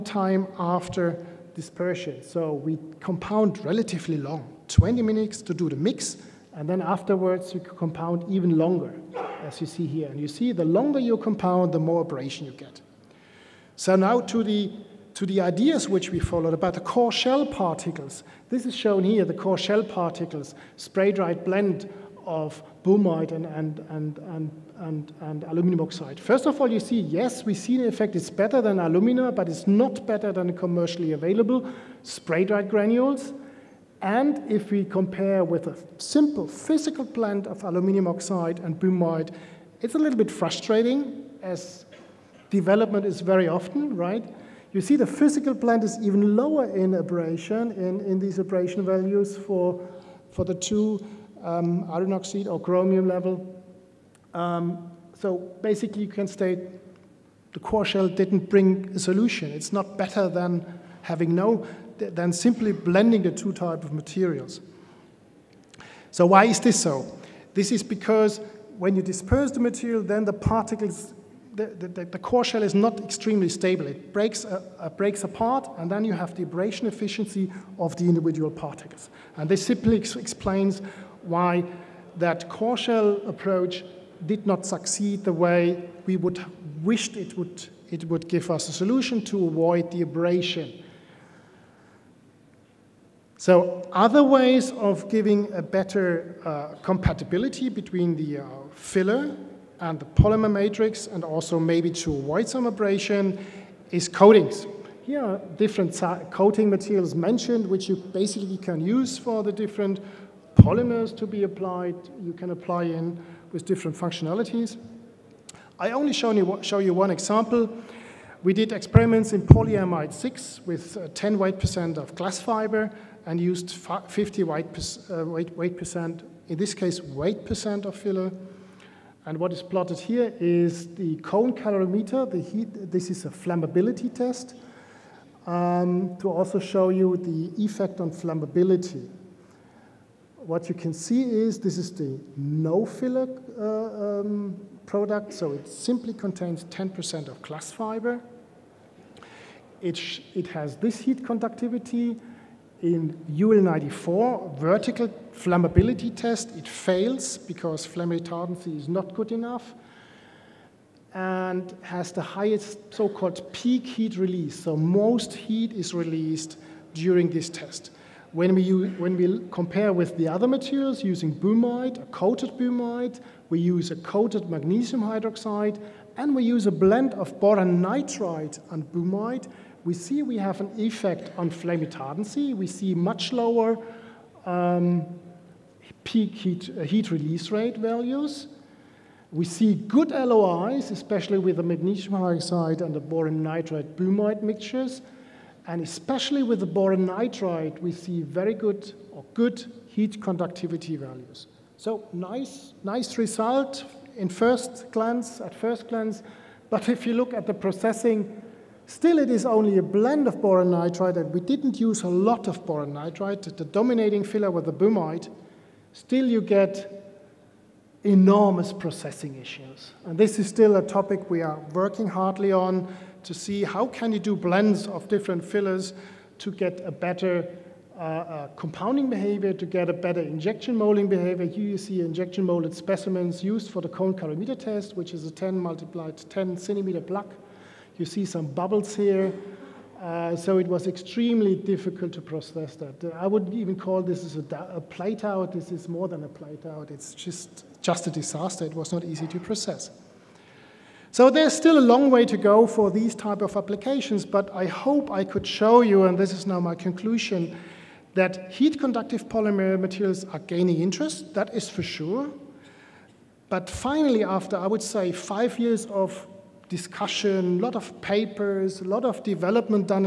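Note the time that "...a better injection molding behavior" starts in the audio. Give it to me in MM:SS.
03:49.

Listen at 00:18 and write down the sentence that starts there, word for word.
This is shown here, the core shell particles, spray-dried blend of boehmite and, and, and, and, and, and, aluminum oxide.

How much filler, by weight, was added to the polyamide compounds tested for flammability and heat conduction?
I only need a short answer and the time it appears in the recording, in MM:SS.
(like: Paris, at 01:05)
50 weight percent, at 02:03.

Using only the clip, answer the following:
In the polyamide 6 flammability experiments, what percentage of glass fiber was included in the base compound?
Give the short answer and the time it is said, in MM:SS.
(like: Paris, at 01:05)
10 weight percent, at 02:01.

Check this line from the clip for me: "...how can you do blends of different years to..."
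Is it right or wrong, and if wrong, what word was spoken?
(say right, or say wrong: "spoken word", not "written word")
wrong: "fillers", not "years".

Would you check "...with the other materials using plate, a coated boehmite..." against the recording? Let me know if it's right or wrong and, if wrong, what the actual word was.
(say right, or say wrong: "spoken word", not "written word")
wrong: "boehmite", not "plate".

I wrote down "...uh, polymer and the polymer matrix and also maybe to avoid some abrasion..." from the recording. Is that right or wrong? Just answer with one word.
wrong.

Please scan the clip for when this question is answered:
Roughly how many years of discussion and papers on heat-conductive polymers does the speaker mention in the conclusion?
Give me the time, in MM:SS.
04:25.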